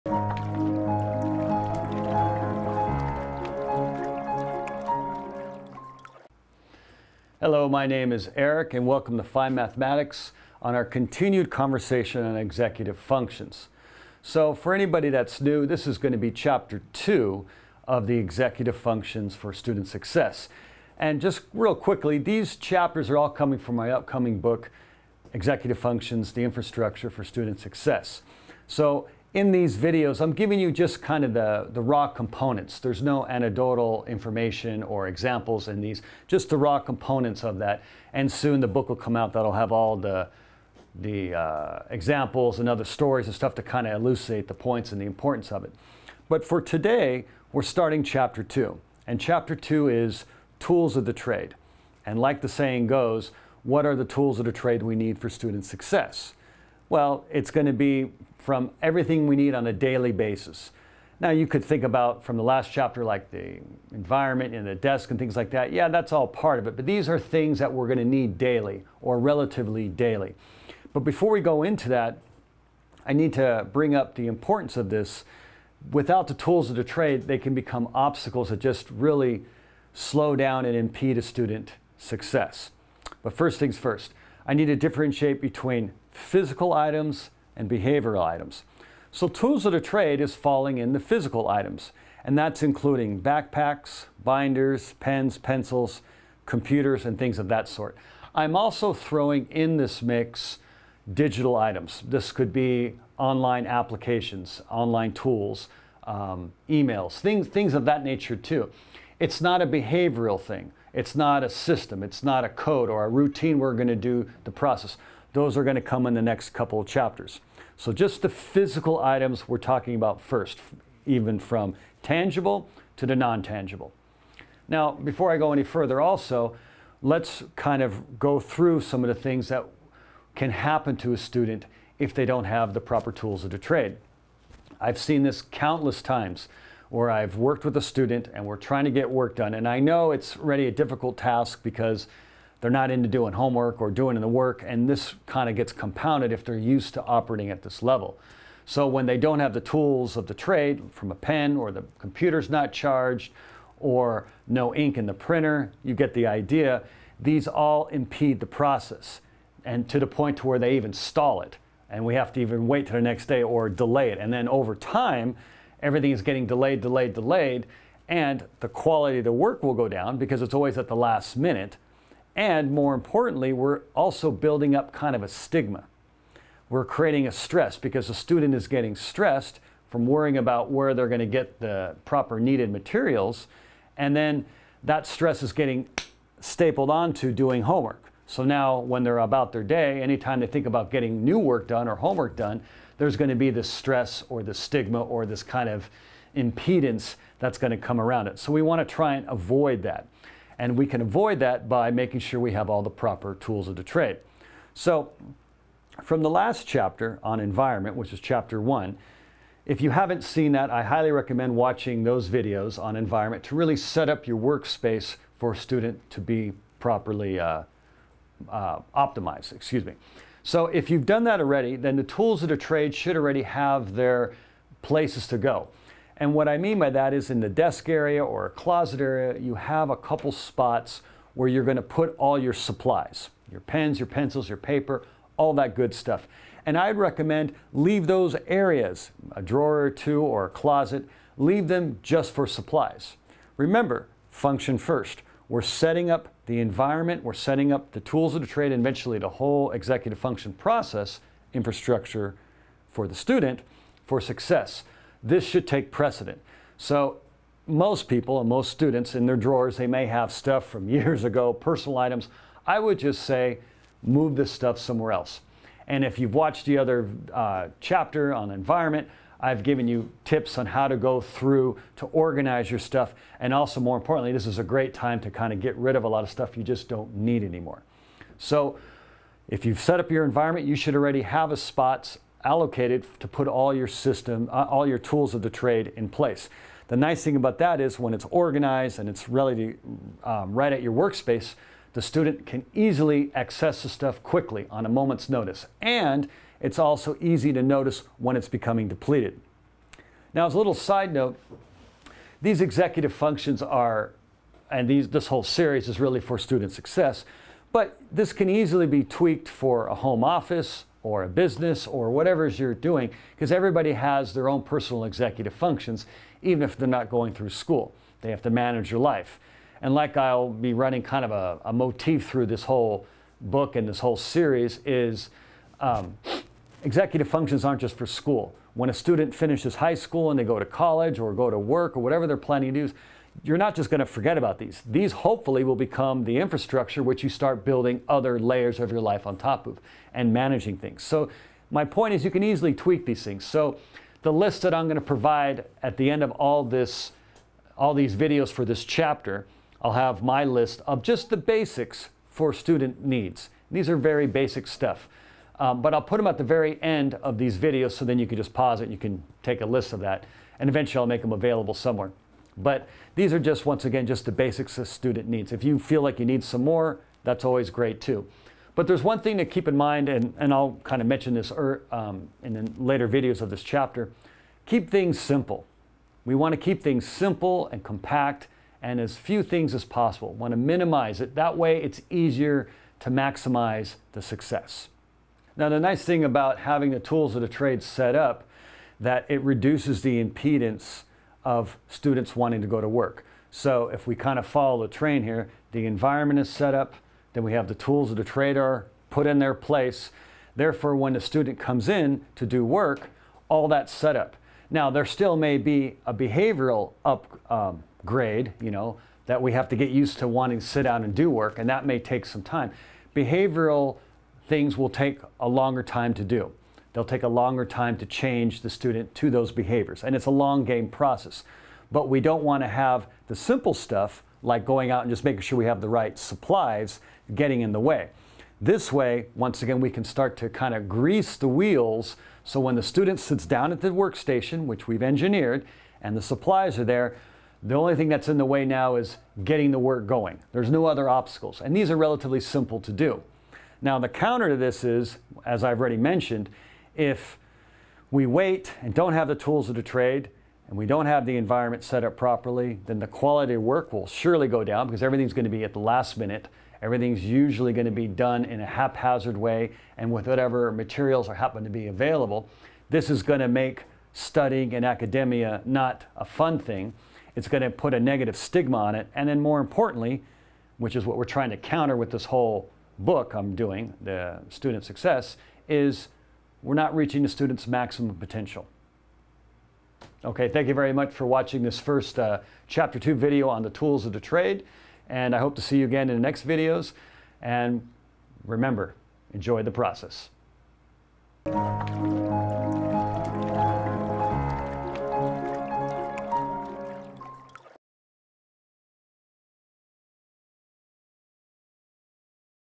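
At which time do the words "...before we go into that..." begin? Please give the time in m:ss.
1:11.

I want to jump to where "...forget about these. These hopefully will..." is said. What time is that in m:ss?
5:34.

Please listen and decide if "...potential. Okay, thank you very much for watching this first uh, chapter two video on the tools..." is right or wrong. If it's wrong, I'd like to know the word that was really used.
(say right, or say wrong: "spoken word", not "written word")
right.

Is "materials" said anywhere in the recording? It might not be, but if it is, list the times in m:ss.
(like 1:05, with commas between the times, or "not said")
3:02, 7:40.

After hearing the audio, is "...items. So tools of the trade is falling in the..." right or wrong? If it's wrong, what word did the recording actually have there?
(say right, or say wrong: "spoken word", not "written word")
right.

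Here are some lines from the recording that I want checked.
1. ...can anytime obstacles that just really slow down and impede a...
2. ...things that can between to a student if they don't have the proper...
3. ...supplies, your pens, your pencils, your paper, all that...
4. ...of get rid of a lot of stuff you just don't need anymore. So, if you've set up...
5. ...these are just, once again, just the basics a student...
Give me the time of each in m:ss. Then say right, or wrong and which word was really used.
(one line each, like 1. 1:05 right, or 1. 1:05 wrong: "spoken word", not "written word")
1. 1:17 wrong: "become", not "anytime"
2. 2:09 wrong: "happen", not "between"
3. 3:52 right
4. 4:35 right
5. 6:03 right.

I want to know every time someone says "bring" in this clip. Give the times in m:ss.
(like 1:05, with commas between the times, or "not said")
1:13.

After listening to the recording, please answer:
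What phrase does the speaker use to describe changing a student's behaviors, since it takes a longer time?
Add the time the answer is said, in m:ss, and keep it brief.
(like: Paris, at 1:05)
A long game process, at 7:00.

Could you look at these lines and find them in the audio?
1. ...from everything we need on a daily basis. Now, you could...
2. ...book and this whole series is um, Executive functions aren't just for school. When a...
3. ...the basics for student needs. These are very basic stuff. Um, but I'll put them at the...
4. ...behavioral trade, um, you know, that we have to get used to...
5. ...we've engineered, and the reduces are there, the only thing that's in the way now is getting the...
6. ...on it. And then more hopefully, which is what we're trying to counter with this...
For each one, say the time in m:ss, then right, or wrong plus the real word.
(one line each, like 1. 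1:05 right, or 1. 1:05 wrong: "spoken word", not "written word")
1. 0:58 right
2. 5:23 right
3. 5:51 right
4. 6:46 wrong: "upgrade", not "trade"
5. 7:14 wrong: "supplies", not "reduces"
6. 7:48 wrong: "importantly", not "hopefully".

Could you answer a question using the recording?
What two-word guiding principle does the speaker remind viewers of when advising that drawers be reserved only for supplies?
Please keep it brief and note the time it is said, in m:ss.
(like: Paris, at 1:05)
Function first, at 4:04.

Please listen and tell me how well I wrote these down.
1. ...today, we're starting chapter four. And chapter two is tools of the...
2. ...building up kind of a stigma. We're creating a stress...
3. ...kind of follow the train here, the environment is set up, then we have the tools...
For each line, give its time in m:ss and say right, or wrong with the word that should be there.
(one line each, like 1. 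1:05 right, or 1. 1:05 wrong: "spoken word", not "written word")
1. 0:46 wrong: "two", not "four"
2. 2:54 right
3. 6:34 right.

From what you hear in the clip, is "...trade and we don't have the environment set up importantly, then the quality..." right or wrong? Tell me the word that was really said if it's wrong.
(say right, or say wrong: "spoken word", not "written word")
wrong: "properly", not "importantly".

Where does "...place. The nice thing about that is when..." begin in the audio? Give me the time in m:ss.
4:46.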